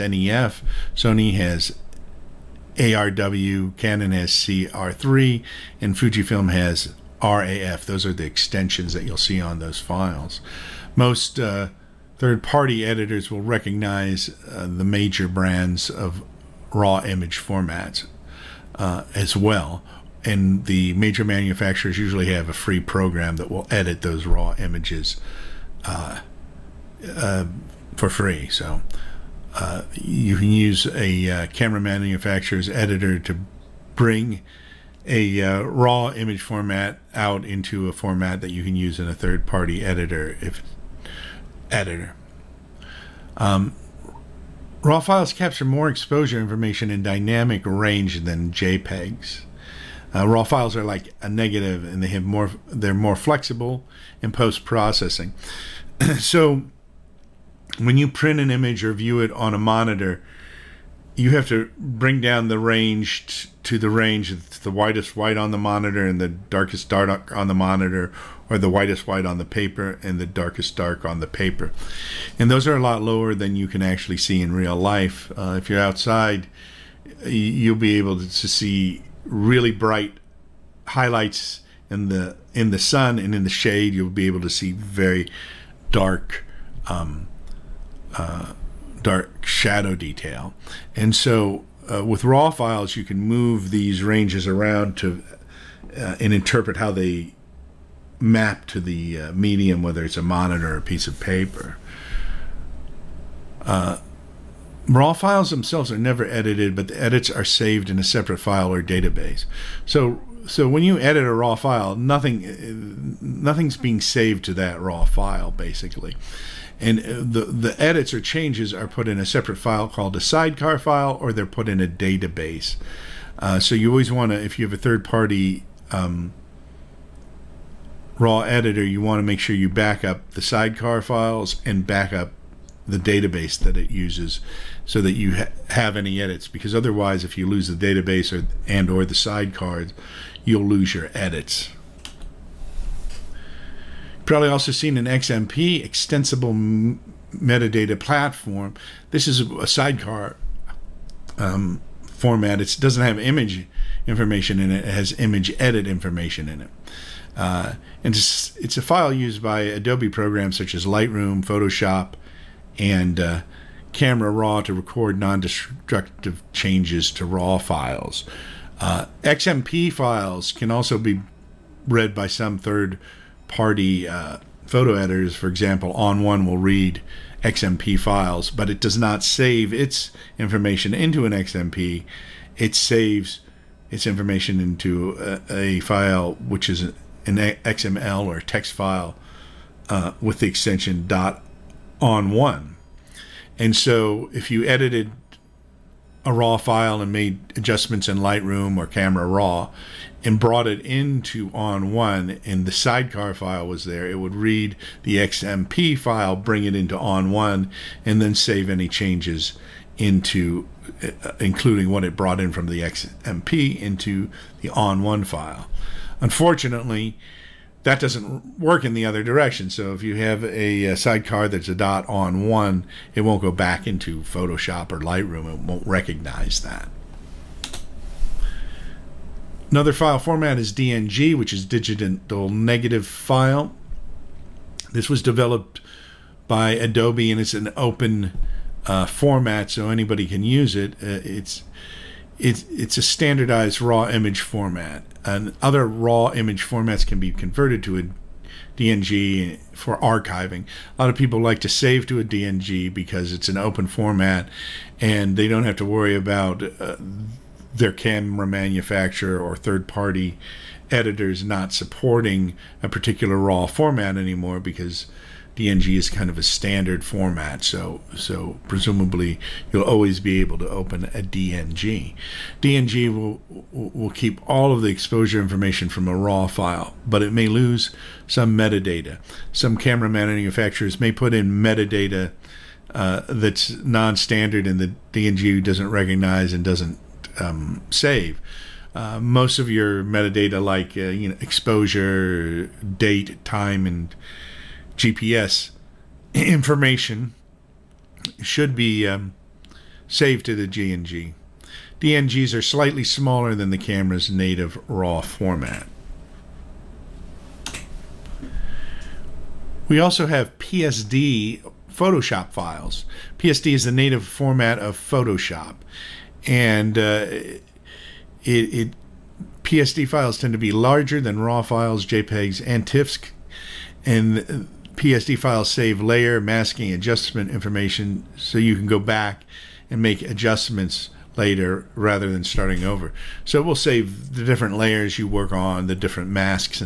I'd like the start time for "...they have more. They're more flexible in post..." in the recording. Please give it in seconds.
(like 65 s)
52 s.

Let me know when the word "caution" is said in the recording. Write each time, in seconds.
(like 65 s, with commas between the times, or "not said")
not said.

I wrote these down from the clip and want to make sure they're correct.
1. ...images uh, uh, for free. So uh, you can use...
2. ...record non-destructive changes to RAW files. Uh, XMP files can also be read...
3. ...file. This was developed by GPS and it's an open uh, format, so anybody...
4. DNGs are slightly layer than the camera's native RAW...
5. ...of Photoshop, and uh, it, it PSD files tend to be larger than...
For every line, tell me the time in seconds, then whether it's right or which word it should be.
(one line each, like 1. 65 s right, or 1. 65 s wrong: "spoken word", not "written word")
1. 24 s right
2. 164 s right
3. 233 s wrong: "Adobe", not "GPS"
4. 301 s wrong: "smaller", not "layer"
5. 314 s right.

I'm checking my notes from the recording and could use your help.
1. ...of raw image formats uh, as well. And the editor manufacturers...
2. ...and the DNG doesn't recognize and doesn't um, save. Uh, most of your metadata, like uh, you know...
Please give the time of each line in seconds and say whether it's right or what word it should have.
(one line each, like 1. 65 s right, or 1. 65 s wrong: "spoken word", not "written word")
1. 15 s wrong: "major", not "editor"
2. 284 s right.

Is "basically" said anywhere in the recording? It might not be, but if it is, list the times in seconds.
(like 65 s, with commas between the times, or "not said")
115 s.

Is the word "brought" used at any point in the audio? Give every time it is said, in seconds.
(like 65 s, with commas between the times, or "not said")
200 s, 212 s.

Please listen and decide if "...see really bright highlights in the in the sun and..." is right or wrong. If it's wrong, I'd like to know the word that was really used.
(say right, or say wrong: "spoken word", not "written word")
right.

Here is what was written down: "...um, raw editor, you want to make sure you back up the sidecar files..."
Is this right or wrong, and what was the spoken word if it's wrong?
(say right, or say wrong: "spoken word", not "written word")
right.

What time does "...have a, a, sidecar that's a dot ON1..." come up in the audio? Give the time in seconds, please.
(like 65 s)
220 s.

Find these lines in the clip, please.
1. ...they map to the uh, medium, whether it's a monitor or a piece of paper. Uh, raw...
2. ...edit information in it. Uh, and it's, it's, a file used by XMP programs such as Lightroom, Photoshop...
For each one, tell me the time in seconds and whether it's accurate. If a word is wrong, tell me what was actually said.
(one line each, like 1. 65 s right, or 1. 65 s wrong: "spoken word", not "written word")
1. 96 s right
2. 155 s wrong: "Adobe", not "XMP".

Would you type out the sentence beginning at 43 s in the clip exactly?
Um, Raw files capture more exposure information in dynamic range than JPEGs.